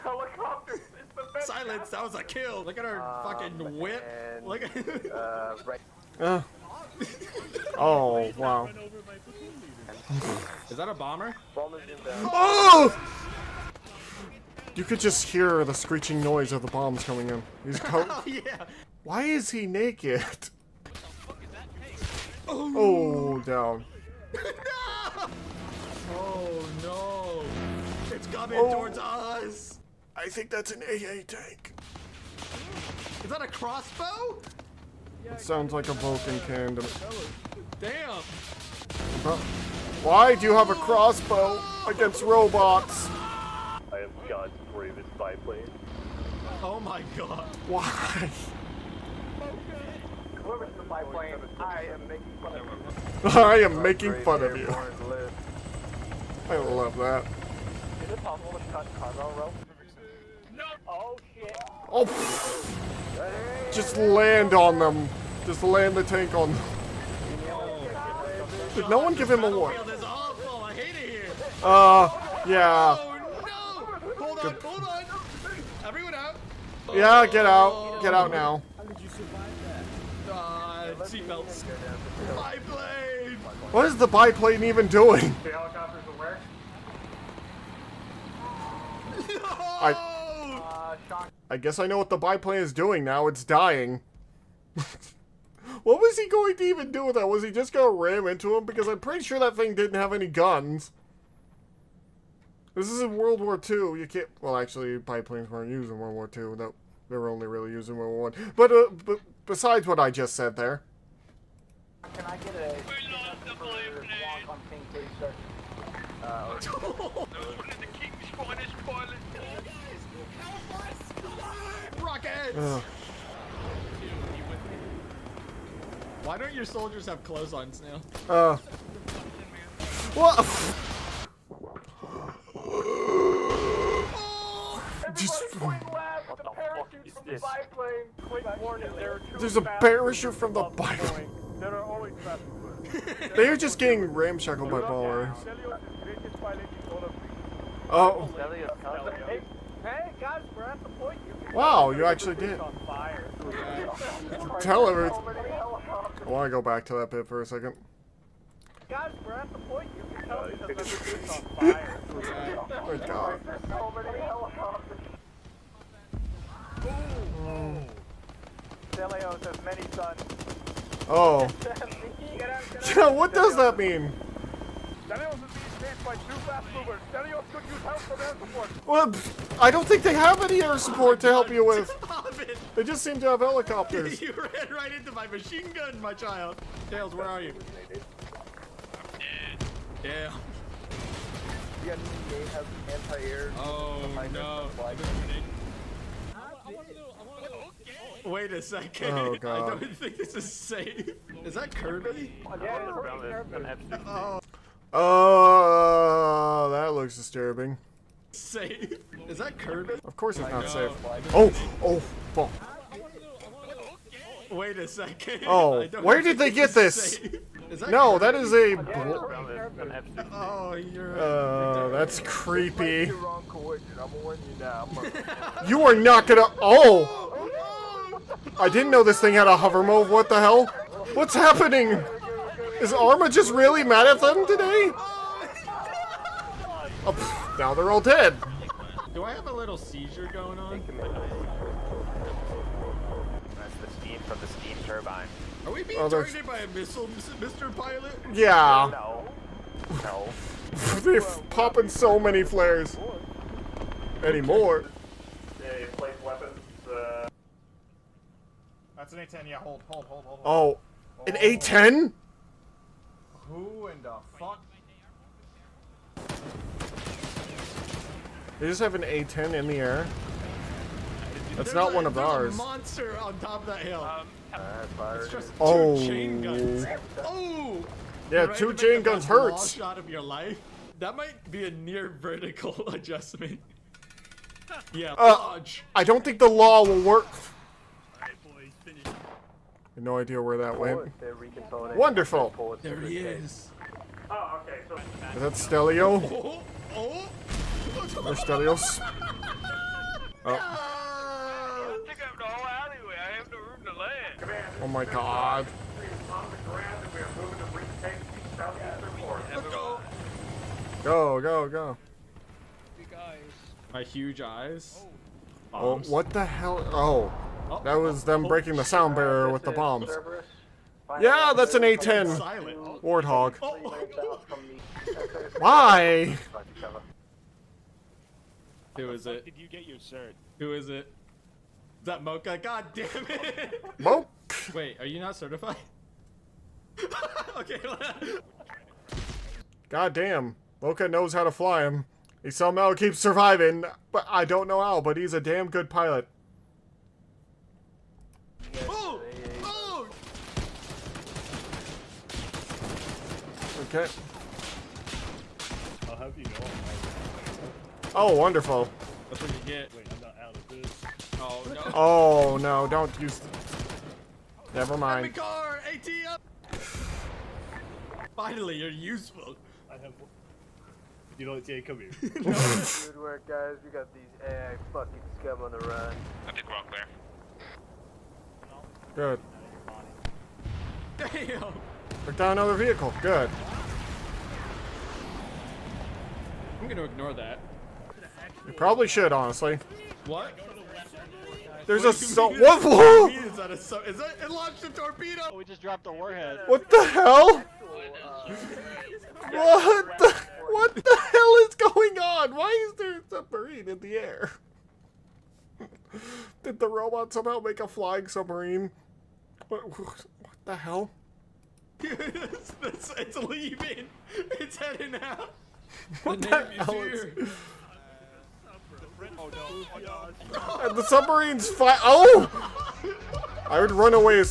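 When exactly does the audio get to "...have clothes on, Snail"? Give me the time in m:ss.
2:07.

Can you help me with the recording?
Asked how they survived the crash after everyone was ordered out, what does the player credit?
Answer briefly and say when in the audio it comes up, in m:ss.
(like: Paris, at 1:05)
Seatbelts, at 1:21.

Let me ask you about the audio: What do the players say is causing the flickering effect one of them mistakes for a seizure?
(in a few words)
Steam turbine.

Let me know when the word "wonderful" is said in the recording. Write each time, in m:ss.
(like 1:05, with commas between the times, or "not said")
4:51, 5:58.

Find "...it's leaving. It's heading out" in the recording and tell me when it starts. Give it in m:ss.
6:53.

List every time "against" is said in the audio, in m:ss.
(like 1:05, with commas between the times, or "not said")
0:41.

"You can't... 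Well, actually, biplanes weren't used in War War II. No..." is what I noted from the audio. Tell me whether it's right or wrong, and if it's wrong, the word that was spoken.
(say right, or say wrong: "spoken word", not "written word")
wrong: "World", not "War".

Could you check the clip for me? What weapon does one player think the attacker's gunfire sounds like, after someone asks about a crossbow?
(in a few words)
Vulcan cannon.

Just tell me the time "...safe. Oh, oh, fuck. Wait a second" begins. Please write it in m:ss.
3:30.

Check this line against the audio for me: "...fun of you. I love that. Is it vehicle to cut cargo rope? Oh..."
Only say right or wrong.
wrong.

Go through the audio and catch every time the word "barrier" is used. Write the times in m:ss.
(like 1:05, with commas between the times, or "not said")
5:19.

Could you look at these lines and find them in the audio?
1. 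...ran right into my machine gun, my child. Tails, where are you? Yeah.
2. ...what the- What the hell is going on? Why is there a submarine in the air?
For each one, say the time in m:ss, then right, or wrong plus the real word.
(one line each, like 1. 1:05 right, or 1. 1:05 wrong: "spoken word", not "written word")
1. 3:04 right
2. 6:39 right.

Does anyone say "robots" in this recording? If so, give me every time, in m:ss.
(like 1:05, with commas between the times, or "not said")
0:42, 6:46.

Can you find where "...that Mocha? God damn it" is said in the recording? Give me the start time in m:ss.
5:32.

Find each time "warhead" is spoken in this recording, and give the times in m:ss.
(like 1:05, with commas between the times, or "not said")
6:36.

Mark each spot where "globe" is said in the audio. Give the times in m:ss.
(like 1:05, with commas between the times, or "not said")
not said.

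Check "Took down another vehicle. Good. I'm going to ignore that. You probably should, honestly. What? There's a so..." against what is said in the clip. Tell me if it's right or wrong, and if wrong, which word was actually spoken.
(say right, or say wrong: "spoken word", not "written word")
right.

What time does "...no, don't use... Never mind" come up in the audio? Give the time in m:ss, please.
6:02.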